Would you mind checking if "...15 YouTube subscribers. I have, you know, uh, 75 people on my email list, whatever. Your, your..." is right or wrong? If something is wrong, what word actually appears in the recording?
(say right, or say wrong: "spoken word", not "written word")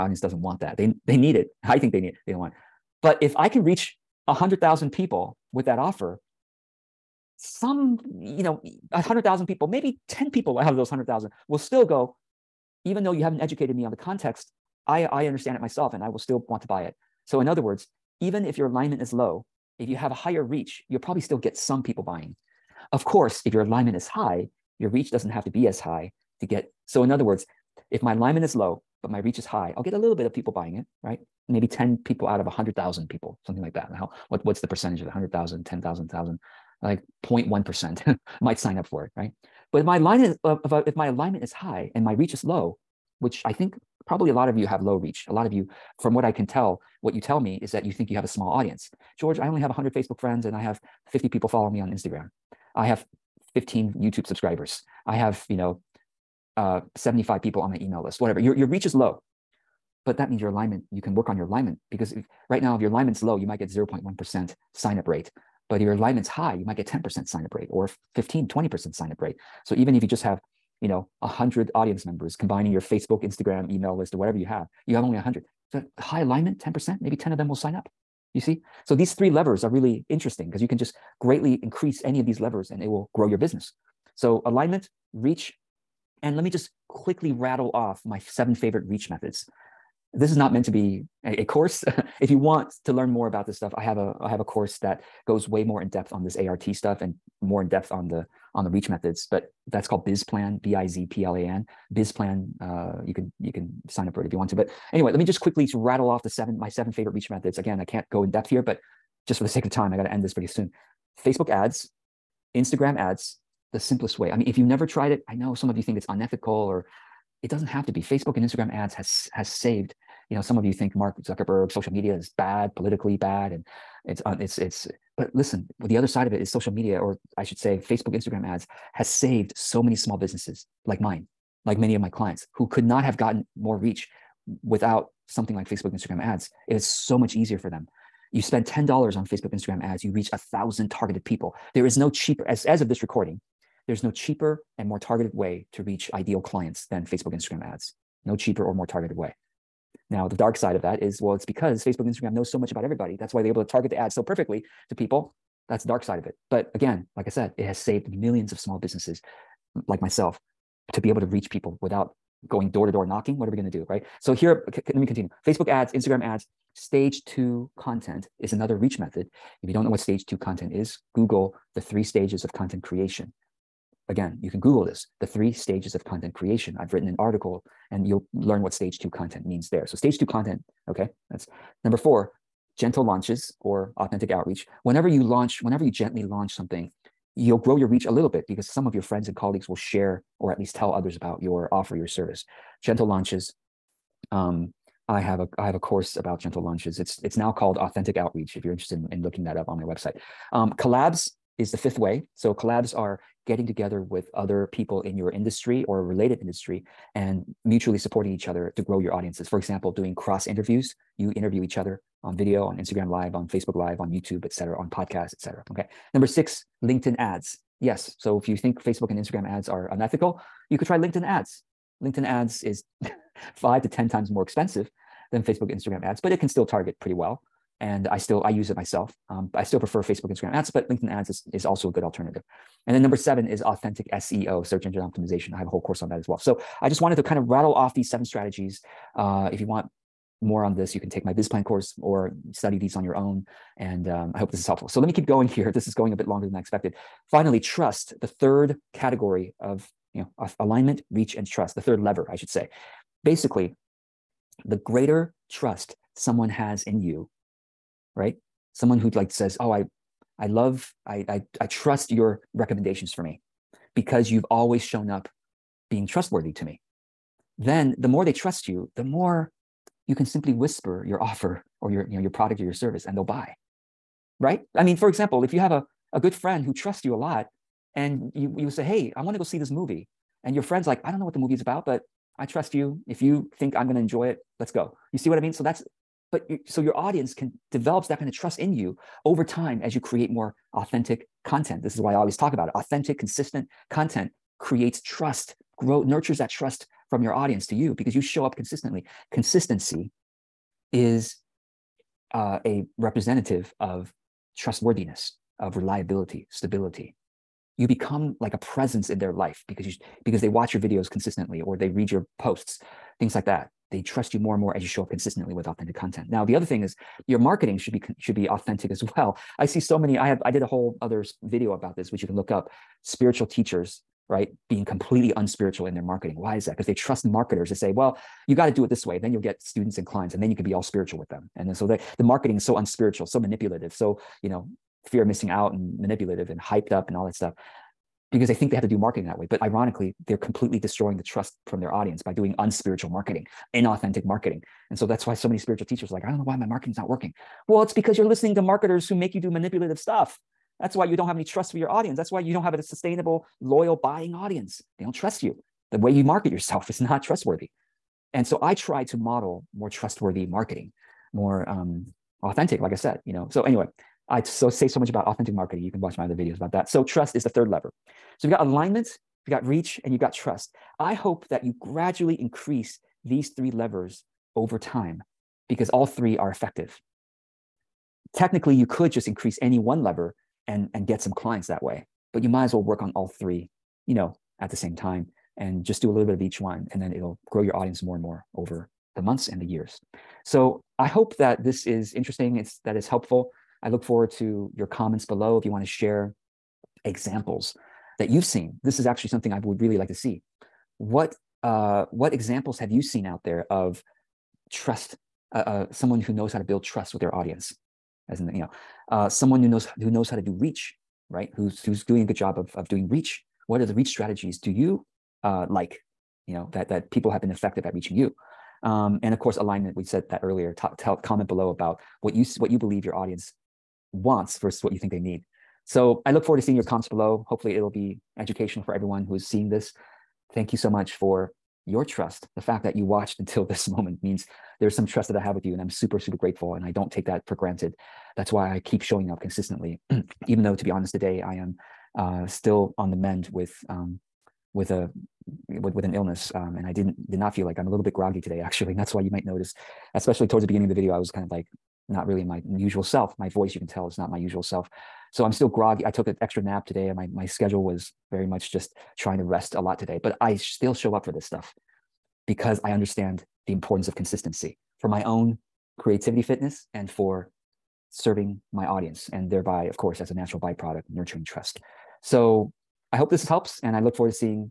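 right.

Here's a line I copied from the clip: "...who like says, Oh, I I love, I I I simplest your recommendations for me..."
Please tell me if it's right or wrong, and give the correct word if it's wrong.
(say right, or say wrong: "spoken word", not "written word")
wrong: "trust", not "simplest".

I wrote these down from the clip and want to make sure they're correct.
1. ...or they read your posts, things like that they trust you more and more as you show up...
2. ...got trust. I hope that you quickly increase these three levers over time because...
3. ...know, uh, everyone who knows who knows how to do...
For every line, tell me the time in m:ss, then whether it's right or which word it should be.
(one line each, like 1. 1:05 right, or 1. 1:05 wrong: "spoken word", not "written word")
1. 5:11 right
2. 6:10 wrong: "gradually", not "quickly"
3. 6:48 wrong: "someone", not "everyone".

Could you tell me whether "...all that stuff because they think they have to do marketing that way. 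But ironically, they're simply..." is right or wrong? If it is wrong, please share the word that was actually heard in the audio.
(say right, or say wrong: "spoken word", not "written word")
wrong: "completely", not "simply".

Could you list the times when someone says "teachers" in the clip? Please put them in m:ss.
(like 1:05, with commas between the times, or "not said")
5:23, 5:45.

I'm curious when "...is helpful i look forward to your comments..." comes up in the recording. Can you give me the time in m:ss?
6:32.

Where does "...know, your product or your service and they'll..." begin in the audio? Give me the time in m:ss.
4:32.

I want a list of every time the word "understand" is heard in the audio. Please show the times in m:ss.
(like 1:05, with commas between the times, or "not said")
0:15, 7:42.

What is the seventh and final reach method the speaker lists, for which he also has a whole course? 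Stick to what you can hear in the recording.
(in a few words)
Authentic SEO.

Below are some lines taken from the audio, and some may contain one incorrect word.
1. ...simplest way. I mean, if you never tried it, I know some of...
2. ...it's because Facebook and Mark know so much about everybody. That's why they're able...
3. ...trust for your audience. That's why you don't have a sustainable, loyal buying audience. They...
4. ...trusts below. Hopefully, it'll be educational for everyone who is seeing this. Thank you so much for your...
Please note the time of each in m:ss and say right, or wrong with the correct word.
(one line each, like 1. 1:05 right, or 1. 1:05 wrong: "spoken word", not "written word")
1. 1:53 right
2. 2:31 wrong: "Instagram", not "Mark"
3. 5:51 right
4. 7:06 wrong: "comments", not "trusts".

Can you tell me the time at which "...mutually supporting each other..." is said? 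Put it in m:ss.
3:27.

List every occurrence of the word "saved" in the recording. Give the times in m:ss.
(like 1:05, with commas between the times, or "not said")
1:59, 2:09, 2:37.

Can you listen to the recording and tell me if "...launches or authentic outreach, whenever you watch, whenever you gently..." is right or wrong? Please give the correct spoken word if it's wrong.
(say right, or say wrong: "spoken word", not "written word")
wrong: "launch", not "watch".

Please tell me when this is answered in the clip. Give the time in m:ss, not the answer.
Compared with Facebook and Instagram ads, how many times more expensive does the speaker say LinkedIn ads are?
3:43.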